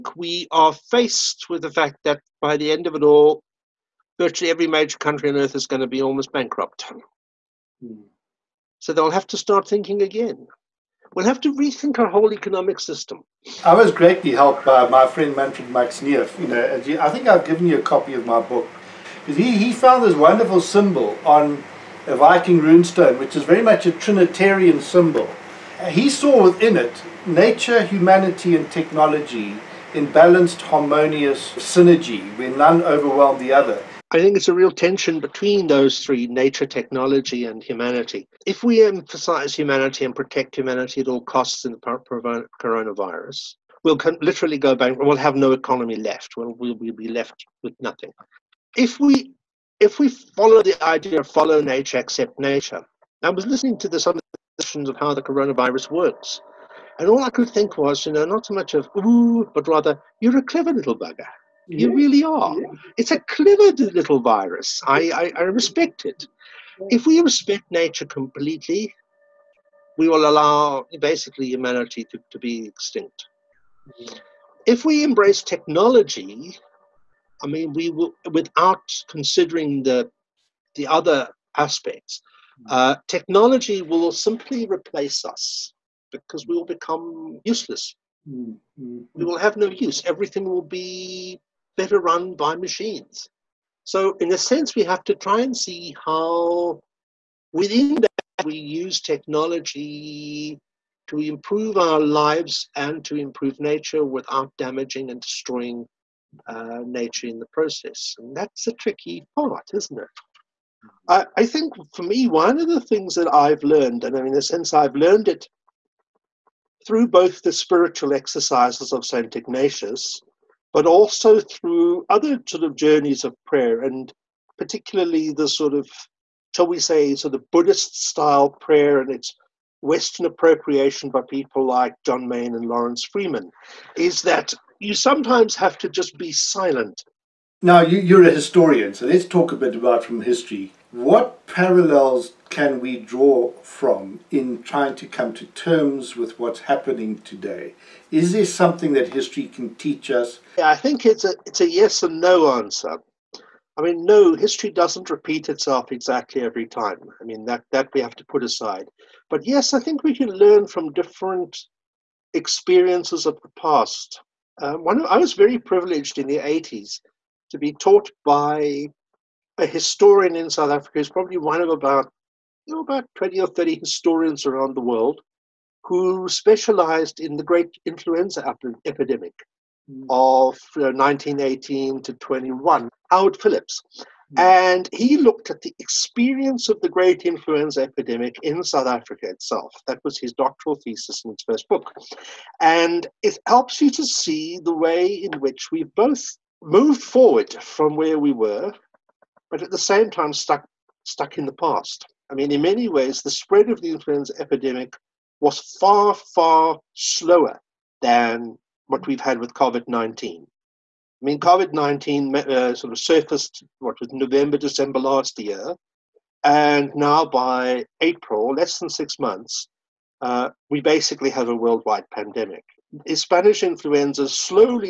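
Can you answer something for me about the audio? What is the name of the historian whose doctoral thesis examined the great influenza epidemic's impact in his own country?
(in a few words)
Howard Phillips.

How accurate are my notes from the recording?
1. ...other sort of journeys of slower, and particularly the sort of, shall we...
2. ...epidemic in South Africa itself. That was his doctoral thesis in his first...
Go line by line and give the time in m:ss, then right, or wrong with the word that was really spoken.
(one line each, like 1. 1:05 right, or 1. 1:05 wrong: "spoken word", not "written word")
1. 2:02 wrong: "prayer", not "slower"
2. 3:07 right.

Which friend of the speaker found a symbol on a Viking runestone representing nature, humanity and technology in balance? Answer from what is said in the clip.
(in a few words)
Manfred Max Neef.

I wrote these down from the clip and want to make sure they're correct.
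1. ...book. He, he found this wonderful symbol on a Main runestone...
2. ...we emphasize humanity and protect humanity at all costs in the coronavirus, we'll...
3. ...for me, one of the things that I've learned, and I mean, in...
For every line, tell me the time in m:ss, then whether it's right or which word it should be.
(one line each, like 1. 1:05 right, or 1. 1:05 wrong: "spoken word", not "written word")
1. 0:18 wrong: "Viking", not "Main"
2. 0:38 right
3. 1:51 right.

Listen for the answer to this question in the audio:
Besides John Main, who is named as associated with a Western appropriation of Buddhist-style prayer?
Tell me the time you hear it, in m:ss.
2:12.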